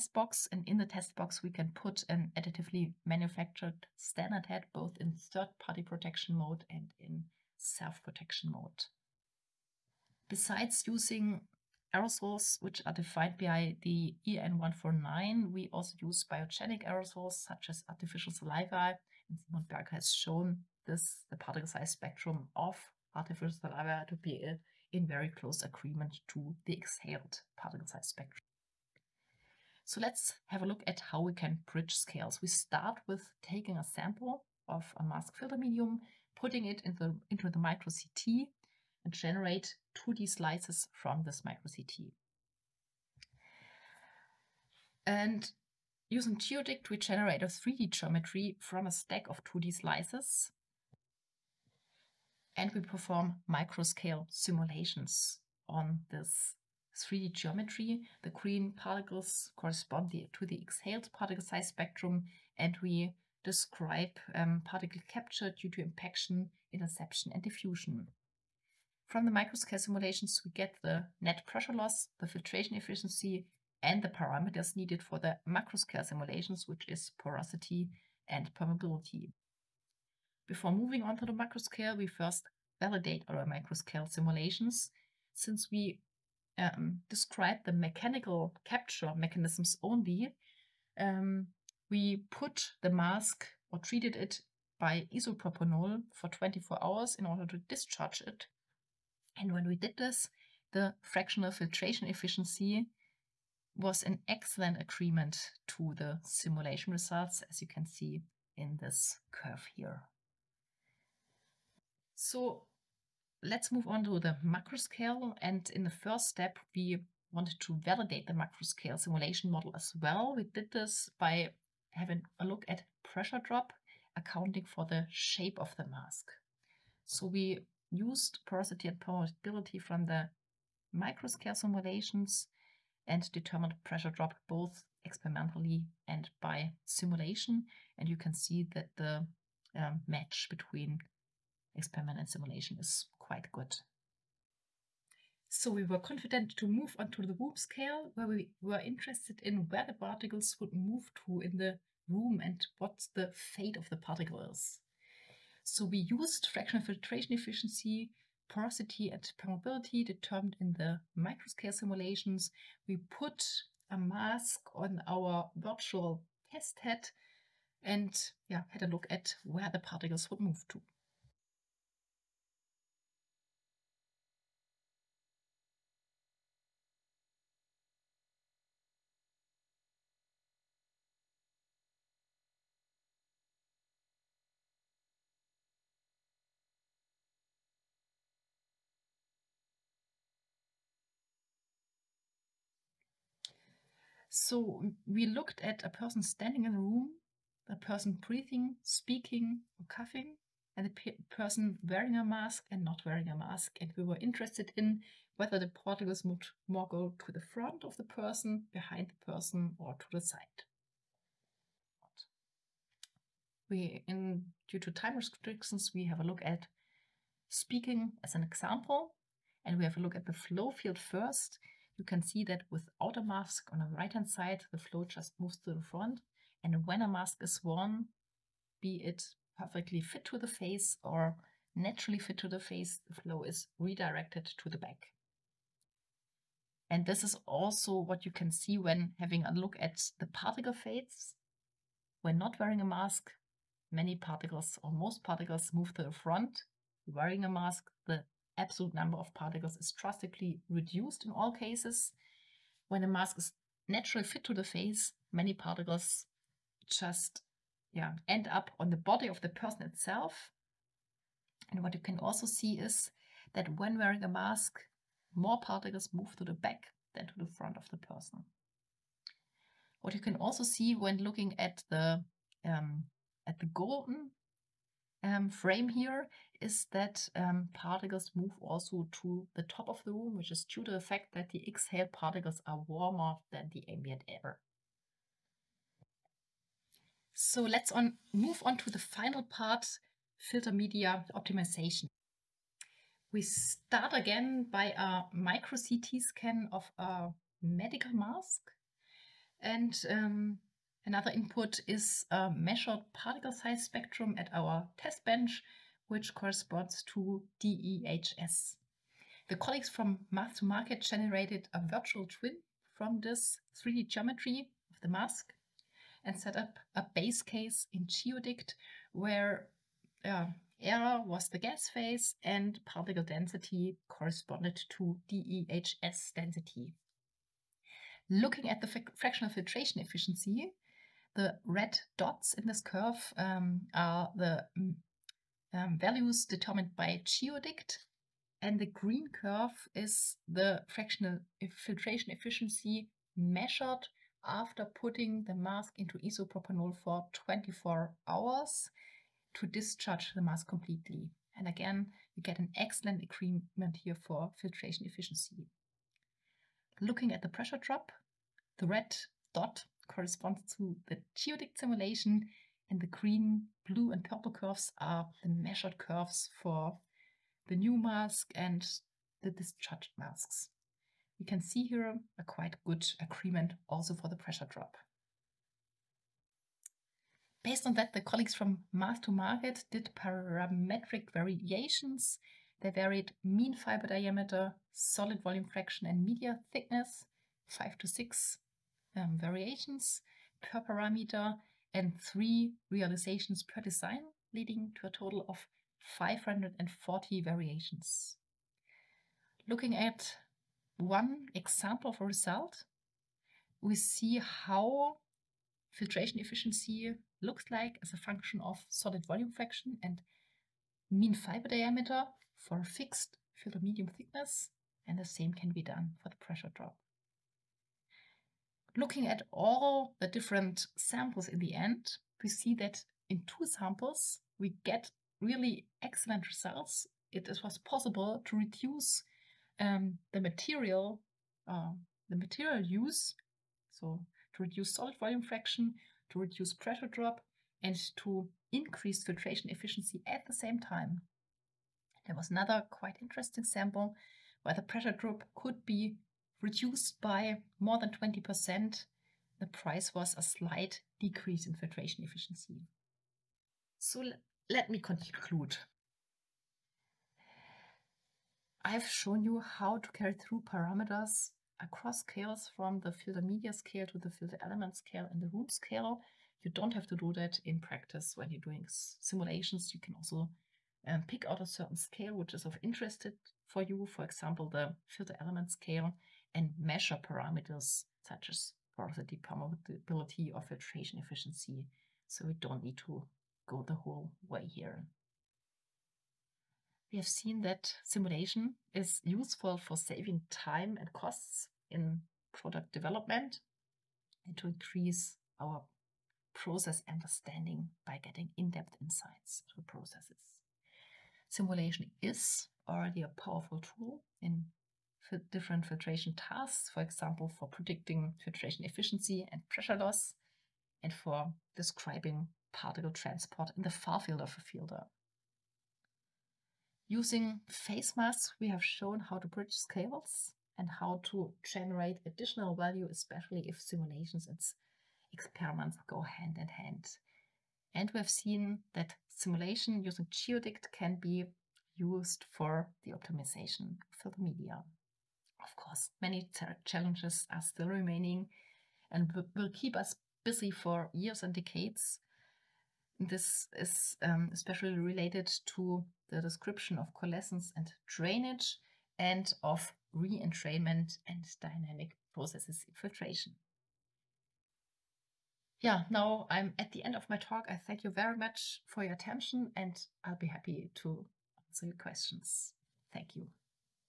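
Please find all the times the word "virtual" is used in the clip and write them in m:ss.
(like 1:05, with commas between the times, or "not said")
2:45, 5:11.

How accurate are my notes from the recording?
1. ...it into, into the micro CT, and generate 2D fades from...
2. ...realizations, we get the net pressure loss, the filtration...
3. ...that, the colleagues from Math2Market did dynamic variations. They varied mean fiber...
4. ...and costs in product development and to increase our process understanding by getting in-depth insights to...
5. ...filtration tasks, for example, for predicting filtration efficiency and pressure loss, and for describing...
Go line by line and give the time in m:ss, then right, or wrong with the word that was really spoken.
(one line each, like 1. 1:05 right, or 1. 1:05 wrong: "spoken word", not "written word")
1. 0:36 wrong: "slices", not "fades"
2. 1:09 wrong: "simulations", not "realizations"
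3. 6:17 wrong: "parametric", not "dynamic"
4. 8:10 right
5. 8:25 right.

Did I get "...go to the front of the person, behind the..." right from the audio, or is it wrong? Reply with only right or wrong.
right.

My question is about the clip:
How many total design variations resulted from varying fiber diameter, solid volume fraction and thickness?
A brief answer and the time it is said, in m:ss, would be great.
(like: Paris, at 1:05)
540, at 6:36.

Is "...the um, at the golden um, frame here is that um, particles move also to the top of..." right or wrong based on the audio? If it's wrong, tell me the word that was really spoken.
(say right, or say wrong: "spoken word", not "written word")
right.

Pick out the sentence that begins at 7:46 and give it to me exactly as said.
You don't have to do that in practice when you're doing simulations.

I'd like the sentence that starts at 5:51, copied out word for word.
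And again, you get an excellent agreement here for filtration efficiency.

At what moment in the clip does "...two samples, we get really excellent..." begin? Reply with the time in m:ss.
7:03.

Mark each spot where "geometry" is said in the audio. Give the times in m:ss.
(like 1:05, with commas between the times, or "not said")
0:47, 0:57, 5:14.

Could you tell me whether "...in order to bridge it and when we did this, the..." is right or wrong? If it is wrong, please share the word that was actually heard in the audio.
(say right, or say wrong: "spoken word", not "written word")
wrong: "discharge", not "bridge".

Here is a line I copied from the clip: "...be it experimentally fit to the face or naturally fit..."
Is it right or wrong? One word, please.
wrong.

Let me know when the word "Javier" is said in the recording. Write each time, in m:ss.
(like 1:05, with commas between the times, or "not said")
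not said.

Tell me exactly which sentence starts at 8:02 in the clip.
So we don't need to go the whole way here.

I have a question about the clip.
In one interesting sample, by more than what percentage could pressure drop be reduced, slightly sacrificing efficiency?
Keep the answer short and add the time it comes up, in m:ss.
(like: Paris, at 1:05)
20%, at 7:28.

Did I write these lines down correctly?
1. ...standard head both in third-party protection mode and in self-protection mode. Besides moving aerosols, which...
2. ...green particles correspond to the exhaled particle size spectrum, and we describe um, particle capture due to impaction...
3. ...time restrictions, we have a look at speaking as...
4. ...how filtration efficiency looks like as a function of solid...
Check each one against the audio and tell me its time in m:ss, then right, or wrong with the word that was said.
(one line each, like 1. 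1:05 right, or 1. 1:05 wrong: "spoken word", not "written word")
1. 0:03 wrong: "using", not "moving"
2. 0:58 right
3. 3:34 right
4. 6:44 right.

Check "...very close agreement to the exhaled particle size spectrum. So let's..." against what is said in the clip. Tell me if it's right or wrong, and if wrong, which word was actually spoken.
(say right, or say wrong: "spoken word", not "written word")
right.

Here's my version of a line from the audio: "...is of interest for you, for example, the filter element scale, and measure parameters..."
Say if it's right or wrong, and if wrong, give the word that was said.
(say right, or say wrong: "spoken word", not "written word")
right.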